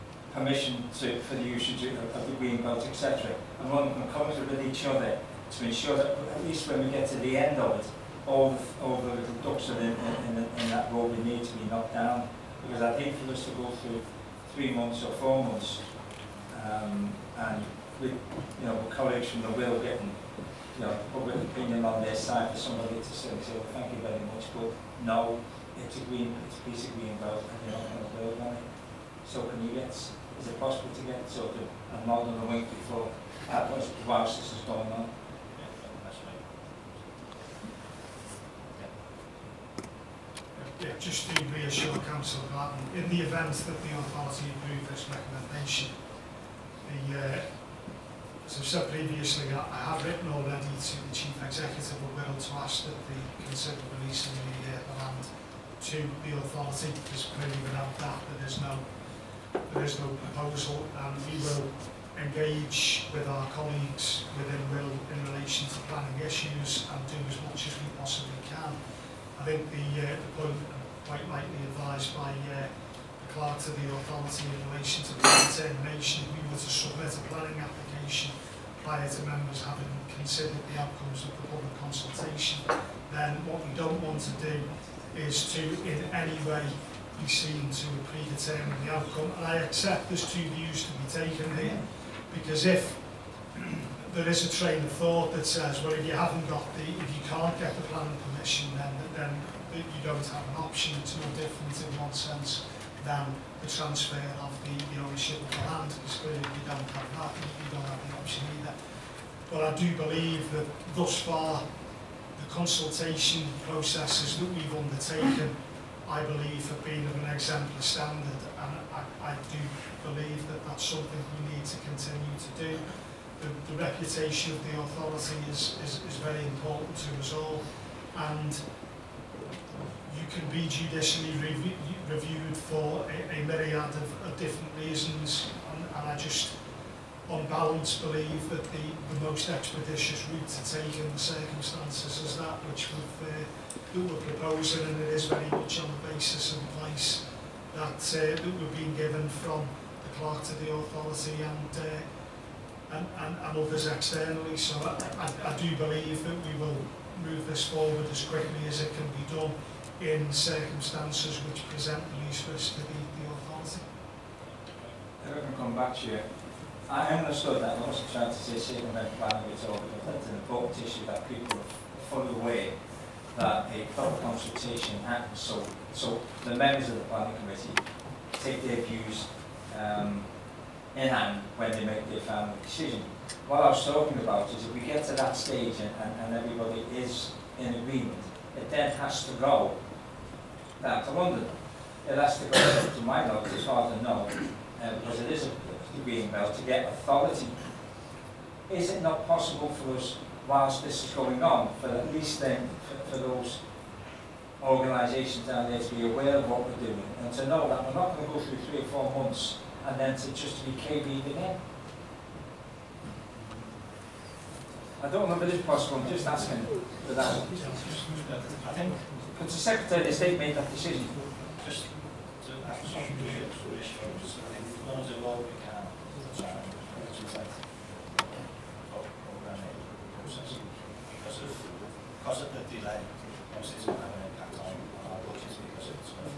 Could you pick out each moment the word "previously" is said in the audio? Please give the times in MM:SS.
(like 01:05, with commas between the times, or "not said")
00:48.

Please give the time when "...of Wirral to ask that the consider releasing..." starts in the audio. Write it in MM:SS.
00:51.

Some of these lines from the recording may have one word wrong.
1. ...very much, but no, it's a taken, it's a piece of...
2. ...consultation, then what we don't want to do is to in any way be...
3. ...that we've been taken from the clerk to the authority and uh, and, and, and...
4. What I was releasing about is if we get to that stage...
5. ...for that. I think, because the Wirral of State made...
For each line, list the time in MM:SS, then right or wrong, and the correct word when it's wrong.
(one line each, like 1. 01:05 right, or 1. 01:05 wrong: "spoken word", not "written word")
1. 00:24 wrong: "green", not "taken"
2. 01:21 right
3. 02:28 wrong: "given", not "taken"
4. 03:03 wrong: "talking", not "releasing"
5. 03:36 wrong: "Secretary", not "Wirral".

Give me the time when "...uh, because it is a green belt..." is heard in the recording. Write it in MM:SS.
03:14.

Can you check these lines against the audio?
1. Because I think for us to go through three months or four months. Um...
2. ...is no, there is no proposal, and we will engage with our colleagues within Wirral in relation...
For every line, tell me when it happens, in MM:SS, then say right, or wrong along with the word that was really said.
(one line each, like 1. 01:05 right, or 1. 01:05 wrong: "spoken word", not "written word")
1. 00:12 right
2. 00:58 right.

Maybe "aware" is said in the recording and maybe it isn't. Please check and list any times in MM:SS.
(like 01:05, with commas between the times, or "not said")
02:52, 03:26.